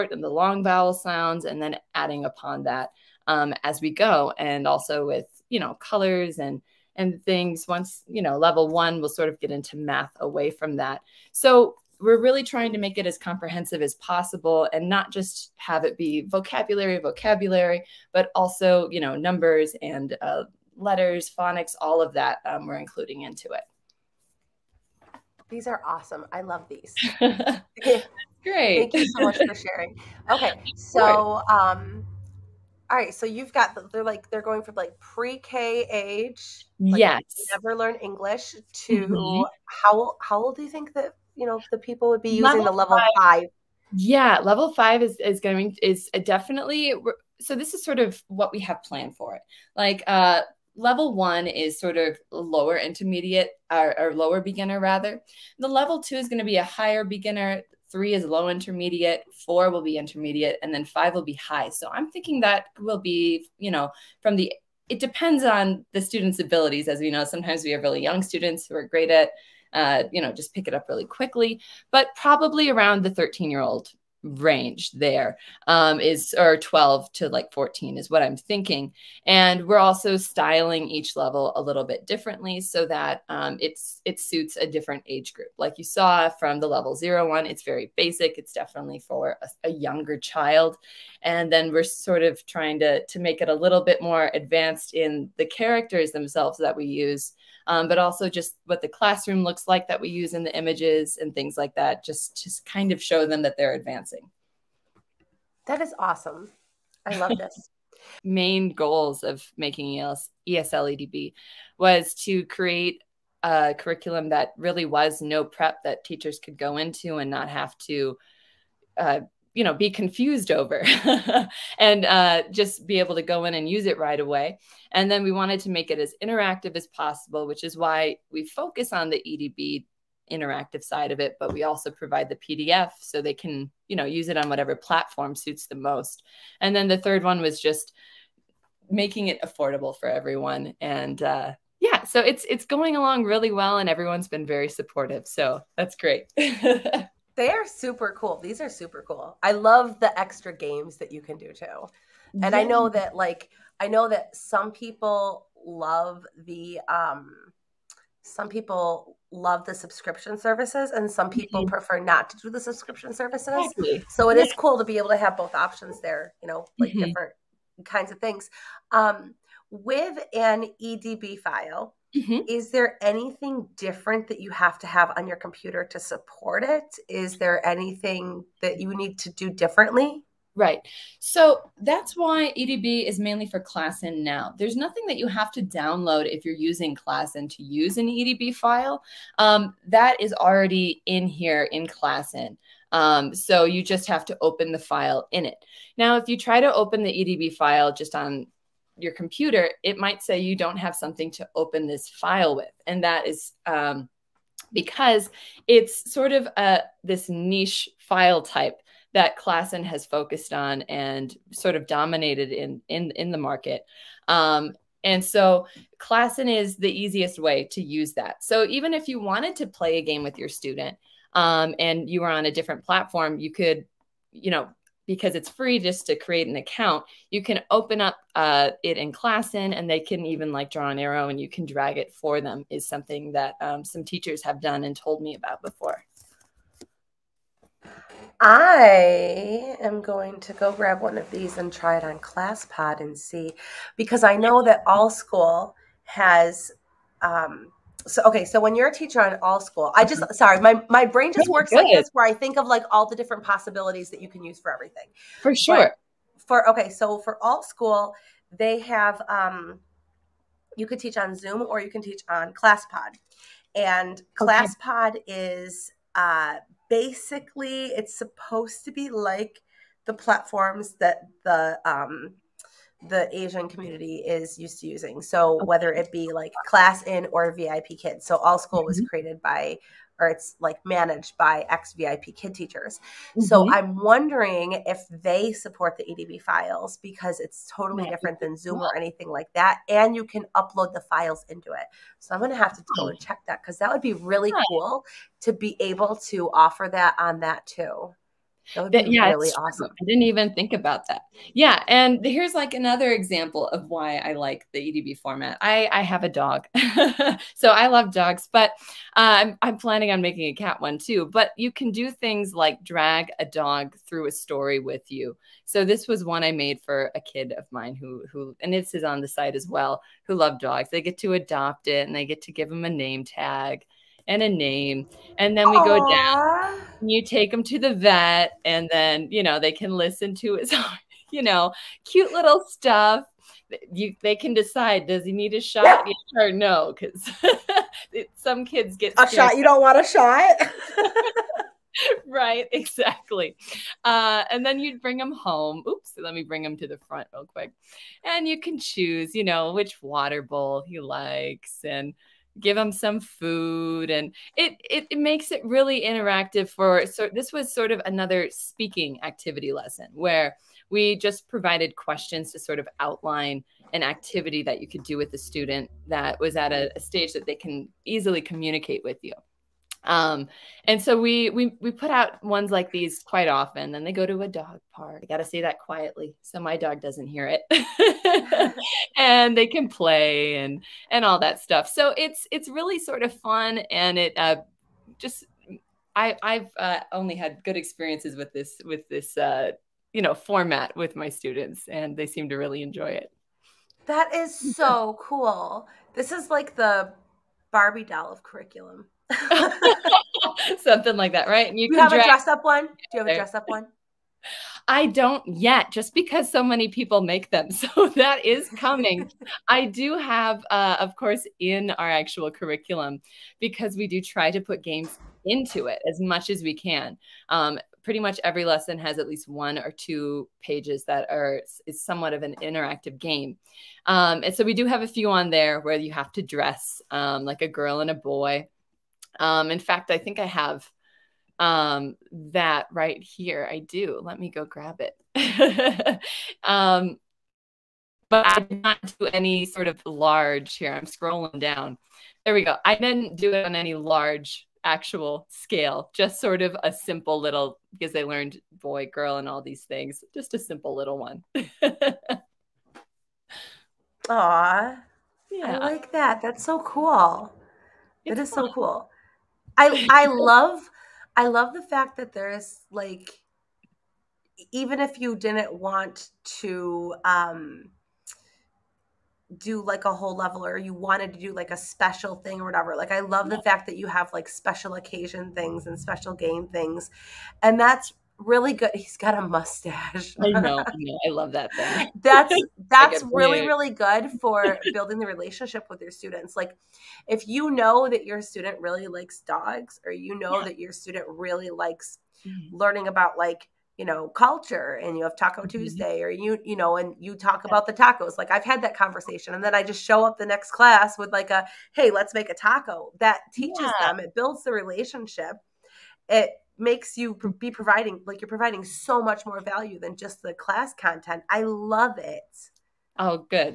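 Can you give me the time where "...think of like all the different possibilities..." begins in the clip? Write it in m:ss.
4:12.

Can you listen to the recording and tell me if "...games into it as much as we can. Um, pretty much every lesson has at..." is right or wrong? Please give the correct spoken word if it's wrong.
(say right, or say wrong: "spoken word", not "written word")
right.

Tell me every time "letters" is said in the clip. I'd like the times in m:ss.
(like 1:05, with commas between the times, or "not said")
0:20.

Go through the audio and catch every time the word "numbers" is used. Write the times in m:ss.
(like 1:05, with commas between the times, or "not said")
0:19.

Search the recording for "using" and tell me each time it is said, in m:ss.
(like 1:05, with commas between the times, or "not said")
0:42, 3:06, 4:34.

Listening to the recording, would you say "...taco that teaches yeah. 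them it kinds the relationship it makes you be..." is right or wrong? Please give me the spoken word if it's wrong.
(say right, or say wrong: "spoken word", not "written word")
wrong: "builds", not "kinds".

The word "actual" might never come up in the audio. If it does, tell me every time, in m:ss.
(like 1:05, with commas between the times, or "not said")
6:52, 7:24.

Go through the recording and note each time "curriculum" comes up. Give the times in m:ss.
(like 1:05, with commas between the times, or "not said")
1:53, 6:38, 6:52.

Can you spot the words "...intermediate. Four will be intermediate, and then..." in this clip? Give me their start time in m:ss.
0:58.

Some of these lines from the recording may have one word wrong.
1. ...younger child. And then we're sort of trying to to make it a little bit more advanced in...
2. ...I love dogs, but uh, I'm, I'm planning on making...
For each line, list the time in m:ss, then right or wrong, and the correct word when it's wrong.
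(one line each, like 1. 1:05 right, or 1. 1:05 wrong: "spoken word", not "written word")
1. 1:29 right
2. 5:07 right.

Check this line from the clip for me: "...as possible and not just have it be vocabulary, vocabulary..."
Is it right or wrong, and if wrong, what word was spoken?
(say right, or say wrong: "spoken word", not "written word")
right.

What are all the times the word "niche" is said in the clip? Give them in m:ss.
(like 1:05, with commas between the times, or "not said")
3:27.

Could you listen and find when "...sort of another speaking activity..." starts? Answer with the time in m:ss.
5:57.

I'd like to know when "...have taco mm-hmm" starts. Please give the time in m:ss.
8:15.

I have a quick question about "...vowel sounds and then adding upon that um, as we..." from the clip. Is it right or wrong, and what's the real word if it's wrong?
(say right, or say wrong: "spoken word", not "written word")
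right.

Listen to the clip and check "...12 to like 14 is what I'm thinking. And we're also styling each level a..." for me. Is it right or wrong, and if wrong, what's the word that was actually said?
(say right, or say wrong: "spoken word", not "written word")
right.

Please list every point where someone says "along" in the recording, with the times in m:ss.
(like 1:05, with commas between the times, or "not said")
2:22.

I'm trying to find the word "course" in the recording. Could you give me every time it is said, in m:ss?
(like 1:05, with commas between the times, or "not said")
6:51.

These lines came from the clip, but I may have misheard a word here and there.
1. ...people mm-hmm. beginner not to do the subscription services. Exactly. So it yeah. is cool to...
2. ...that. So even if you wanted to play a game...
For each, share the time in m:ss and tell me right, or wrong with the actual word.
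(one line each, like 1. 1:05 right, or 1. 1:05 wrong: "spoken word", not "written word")
1. 2:41 wrong: "prefer", not "beginner"
2. 3:38 right.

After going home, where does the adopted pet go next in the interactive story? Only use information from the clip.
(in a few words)
Dog park.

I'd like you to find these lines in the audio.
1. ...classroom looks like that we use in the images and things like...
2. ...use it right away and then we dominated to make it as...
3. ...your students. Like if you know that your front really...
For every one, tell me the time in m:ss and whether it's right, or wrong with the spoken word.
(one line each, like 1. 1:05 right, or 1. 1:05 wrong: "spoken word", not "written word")
1. 1:38 right
2. 2:03 wrong: "wanted", not "dominated"
3. 8:06 wrong: "student", not "front".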